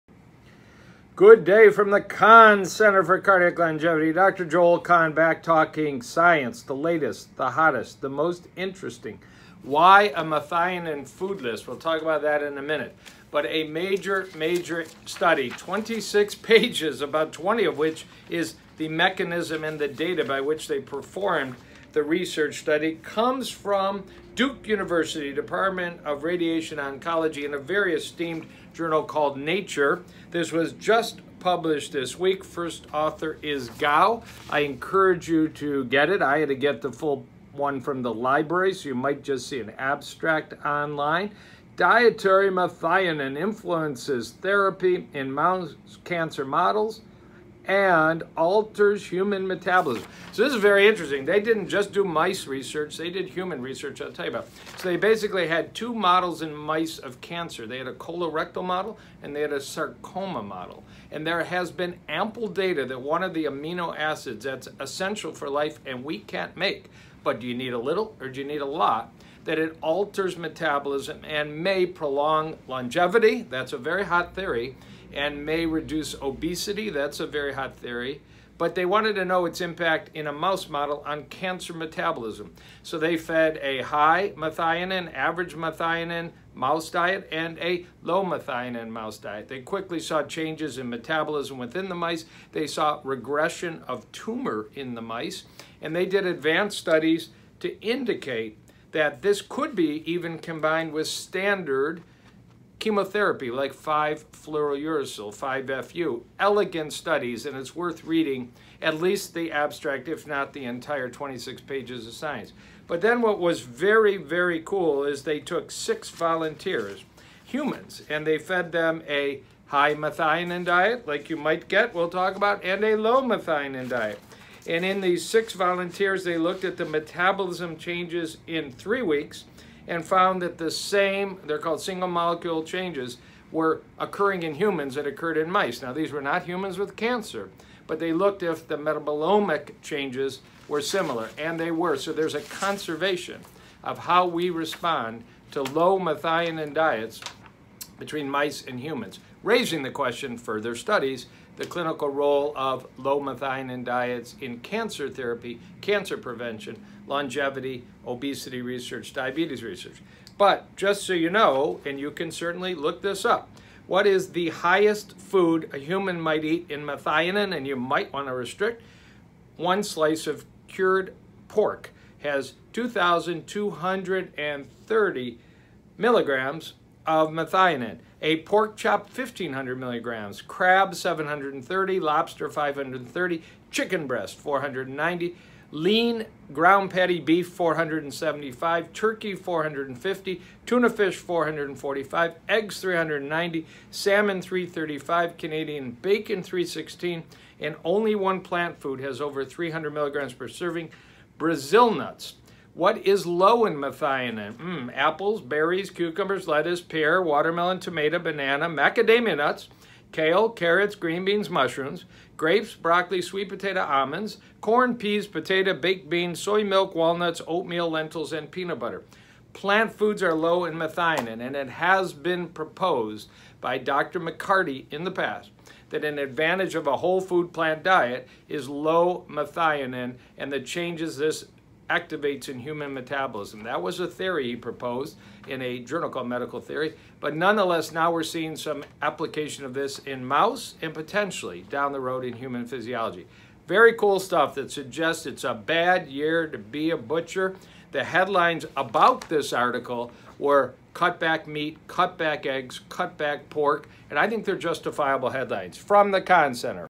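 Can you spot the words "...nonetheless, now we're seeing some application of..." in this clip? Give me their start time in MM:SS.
03:57.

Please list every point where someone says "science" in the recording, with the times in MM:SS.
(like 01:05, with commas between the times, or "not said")
00:06, 01:52.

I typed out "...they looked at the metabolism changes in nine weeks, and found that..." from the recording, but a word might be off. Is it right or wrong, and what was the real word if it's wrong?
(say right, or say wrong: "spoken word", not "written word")
wrong: "three", not "nine".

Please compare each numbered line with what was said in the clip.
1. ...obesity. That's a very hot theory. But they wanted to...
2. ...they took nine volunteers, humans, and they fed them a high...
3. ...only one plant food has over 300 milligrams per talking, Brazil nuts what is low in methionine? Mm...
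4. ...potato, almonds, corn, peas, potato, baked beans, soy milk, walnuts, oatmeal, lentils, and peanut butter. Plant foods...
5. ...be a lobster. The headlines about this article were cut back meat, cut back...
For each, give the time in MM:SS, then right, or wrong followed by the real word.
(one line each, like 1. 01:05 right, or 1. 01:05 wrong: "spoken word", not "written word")
1. 01:16 right
2. 01:55 wrong: "six", not "nine"
3. 03:17 wrong: "serving", not "talking"
4. 03:33 right
5. 04:06 wrong: "butcher", not "lobster".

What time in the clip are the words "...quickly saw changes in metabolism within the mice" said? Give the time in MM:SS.
01:29.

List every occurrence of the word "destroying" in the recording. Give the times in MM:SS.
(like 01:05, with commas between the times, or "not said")
not said.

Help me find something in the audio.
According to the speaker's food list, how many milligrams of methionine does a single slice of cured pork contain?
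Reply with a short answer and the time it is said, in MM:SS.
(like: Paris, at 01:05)
2,230 milligrams, at 02:52.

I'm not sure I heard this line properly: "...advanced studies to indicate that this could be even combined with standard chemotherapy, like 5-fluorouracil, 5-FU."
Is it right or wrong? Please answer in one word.
right.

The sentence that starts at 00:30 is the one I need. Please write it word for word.
This was just published this week.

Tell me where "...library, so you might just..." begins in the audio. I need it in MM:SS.
00:38.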